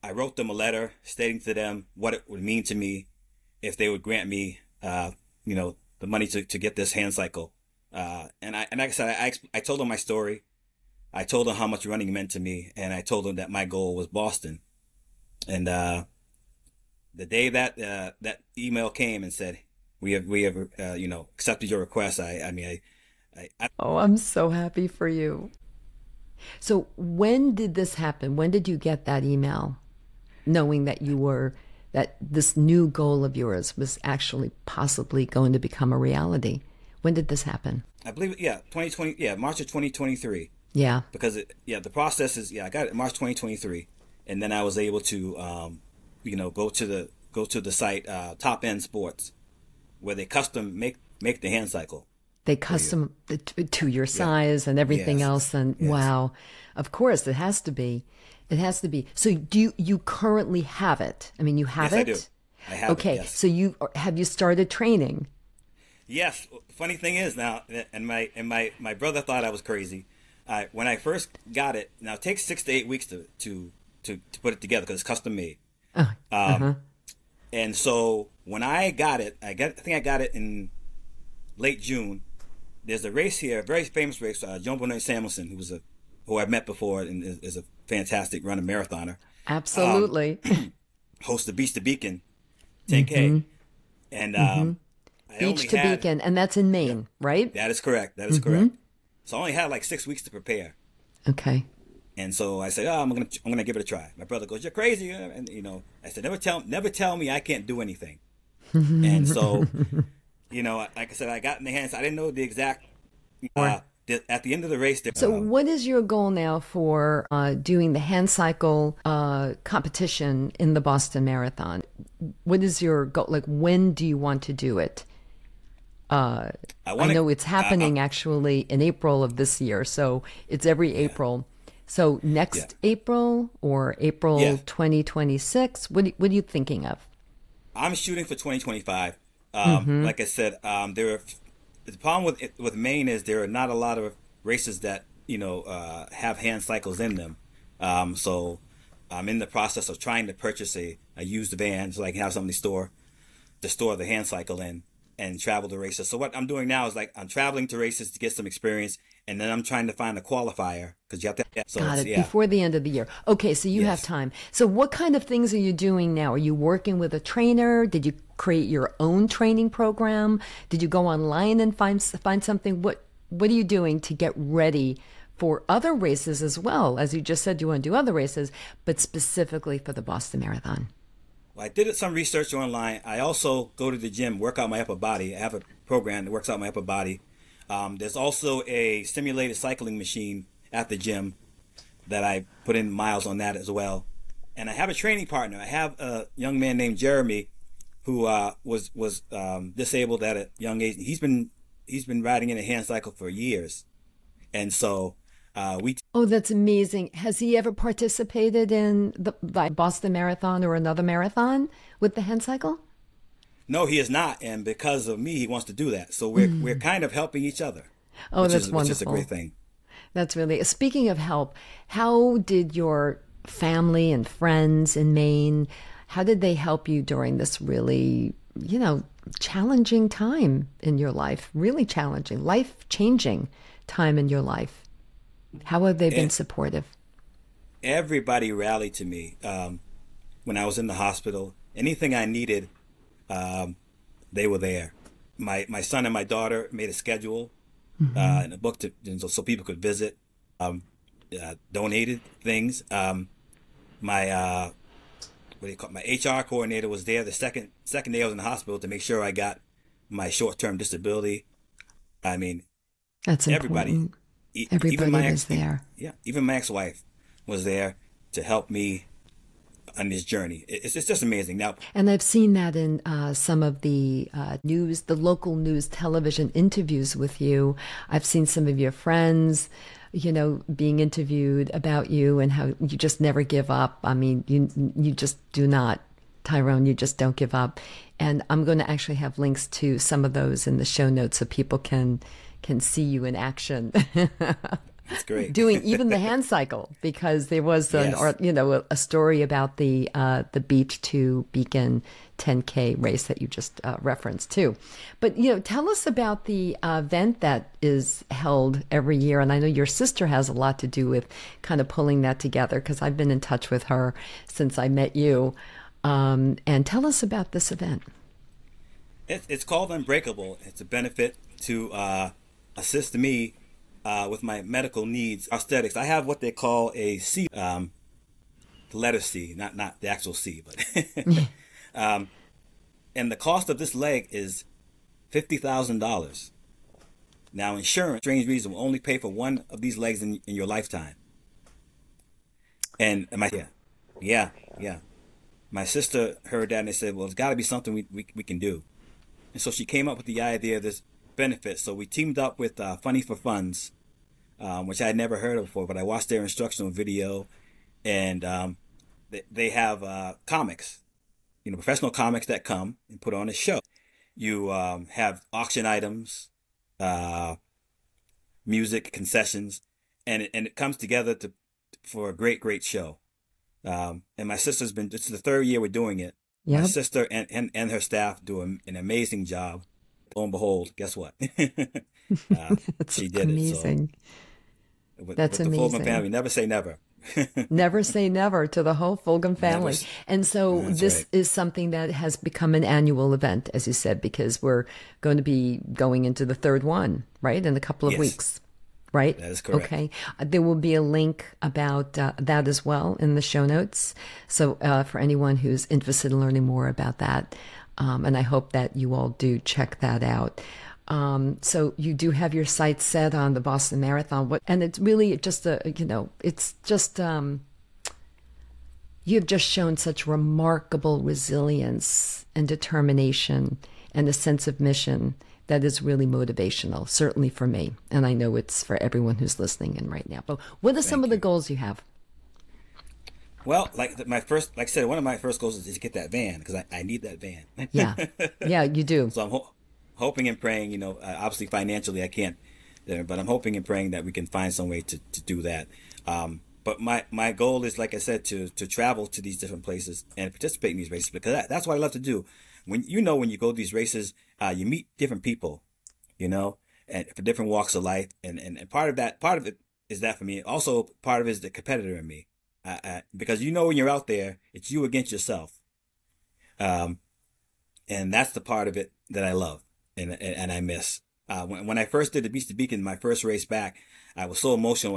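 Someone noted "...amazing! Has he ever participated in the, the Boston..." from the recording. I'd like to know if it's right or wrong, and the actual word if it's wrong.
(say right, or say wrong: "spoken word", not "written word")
right.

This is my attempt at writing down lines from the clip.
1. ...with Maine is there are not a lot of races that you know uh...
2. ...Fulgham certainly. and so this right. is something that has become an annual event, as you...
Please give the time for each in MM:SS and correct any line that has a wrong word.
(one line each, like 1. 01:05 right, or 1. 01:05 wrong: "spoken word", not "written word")
1. 02:22 right
2. 06:29 wrong: "family", not "certainly".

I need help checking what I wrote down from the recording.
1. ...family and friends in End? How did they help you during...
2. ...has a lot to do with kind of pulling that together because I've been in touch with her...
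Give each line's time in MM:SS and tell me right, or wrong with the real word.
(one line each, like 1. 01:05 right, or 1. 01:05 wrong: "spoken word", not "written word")
1. 03:43 wrong: "Maine", not "End"
2. 05:10 right.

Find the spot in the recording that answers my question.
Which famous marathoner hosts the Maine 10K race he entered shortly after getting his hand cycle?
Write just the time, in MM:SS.
01:24.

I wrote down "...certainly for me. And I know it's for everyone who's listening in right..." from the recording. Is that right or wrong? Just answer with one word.
right.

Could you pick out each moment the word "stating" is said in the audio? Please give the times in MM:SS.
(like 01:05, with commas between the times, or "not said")
00:01.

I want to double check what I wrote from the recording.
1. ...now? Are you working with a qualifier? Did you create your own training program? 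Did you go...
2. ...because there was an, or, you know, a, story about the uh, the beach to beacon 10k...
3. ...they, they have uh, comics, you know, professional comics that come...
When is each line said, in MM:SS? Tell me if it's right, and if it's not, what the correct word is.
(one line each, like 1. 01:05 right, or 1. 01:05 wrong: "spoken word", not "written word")
1. 02:46 wrong: "trainer", not "qualifier"
2. 04:57 right
3. 05:59 right.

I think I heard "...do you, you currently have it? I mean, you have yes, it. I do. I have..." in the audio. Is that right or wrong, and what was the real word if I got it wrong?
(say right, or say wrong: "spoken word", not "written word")
right.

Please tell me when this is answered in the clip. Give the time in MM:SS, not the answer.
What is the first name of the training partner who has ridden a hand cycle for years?
03:16.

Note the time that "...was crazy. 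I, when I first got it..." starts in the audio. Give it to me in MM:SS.
01:09.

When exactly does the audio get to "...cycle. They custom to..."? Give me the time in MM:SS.
00:51.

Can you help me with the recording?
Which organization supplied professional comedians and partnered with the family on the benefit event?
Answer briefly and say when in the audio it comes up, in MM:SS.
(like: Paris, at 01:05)
Funny for Funds, at 05:52.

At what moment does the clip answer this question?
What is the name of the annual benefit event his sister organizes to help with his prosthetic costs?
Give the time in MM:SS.
05:19.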